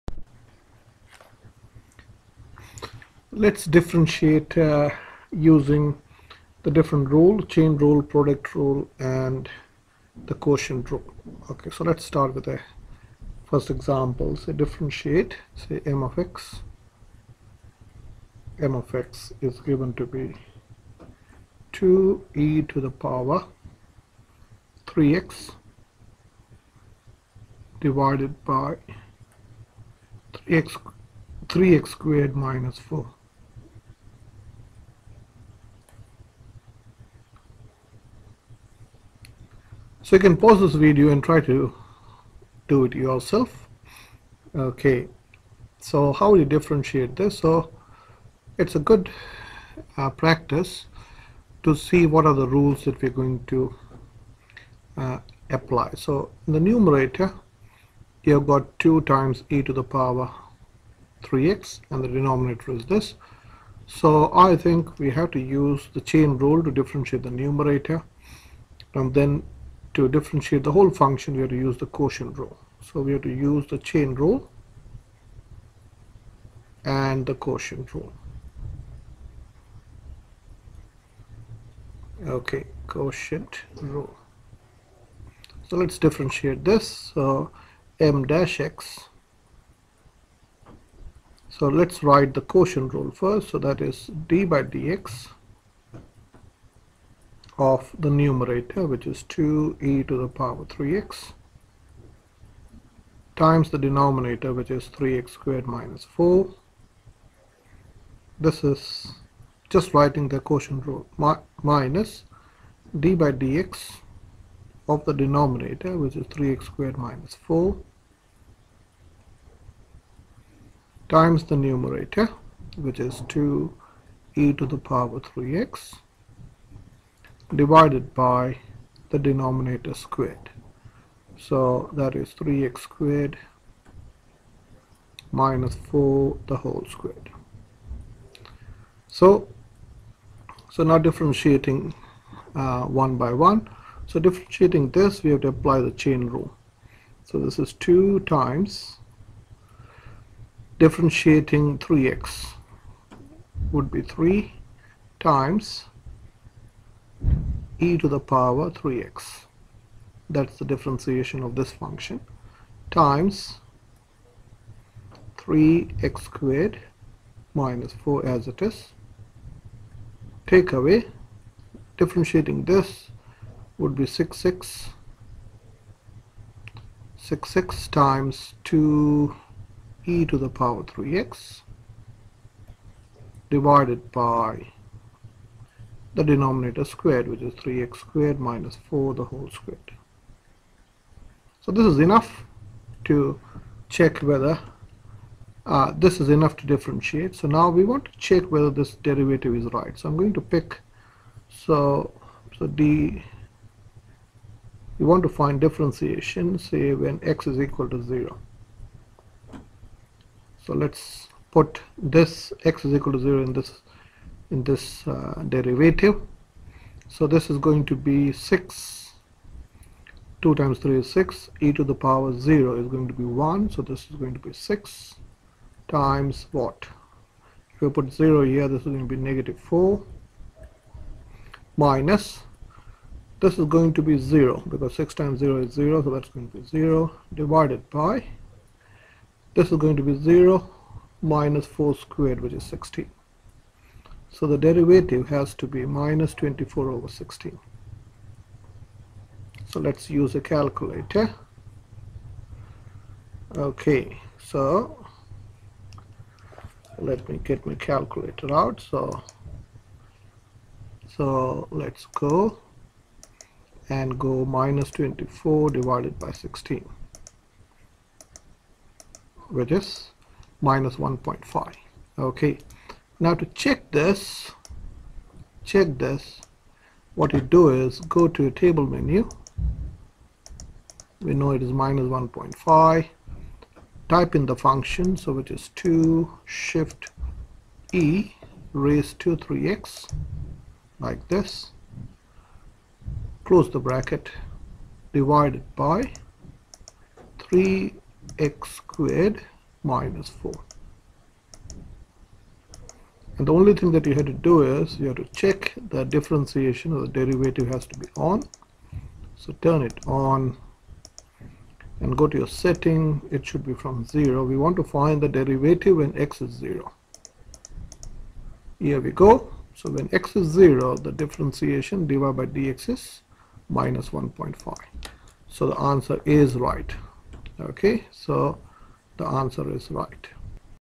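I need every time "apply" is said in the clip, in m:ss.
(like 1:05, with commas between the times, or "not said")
0:55, 2:25.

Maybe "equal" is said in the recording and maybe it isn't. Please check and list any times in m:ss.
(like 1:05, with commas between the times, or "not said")
3:27, 3:32.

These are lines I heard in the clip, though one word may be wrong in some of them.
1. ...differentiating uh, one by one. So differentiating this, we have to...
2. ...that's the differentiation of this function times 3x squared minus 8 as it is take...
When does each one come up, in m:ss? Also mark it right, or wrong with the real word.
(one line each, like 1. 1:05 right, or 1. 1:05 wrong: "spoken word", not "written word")
1. 2:20 right
2. 2:40 wrong: "4", not "8".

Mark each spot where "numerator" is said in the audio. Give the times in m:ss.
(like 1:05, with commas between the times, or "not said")
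0:56, 1:07, 1:38, 2:01.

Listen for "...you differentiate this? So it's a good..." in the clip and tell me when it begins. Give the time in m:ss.
0:46.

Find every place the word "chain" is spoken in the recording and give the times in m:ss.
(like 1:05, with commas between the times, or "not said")
0:07, 1:06, 1:13, 2:25.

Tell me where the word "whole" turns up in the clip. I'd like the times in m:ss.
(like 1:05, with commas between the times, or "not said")
1:10, 2:16, 3:09.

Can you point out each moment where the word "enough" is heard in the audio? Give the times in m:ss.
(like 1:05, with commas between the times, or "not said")
3:11, 3:16.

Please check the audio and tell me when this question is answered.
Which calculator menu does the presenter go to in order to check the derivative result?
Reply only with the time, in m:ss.
4:38.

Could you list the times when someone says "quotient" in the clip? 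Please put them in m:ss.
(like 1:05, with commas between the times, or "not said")
0:10, 1:11, 1:17, 1:22, 1:32, 1:50.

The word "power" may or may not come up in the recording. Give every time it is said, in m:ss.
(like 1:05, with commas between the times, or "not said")
0:22, 0:59, 1:40, 2:04, 2:38, 3:00, 3:42.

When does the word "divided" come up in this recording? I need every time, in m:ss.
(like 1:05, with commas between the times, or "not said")
0:27, 2:07, 3:03, 3:57, 4:25, 4:55, 5:22.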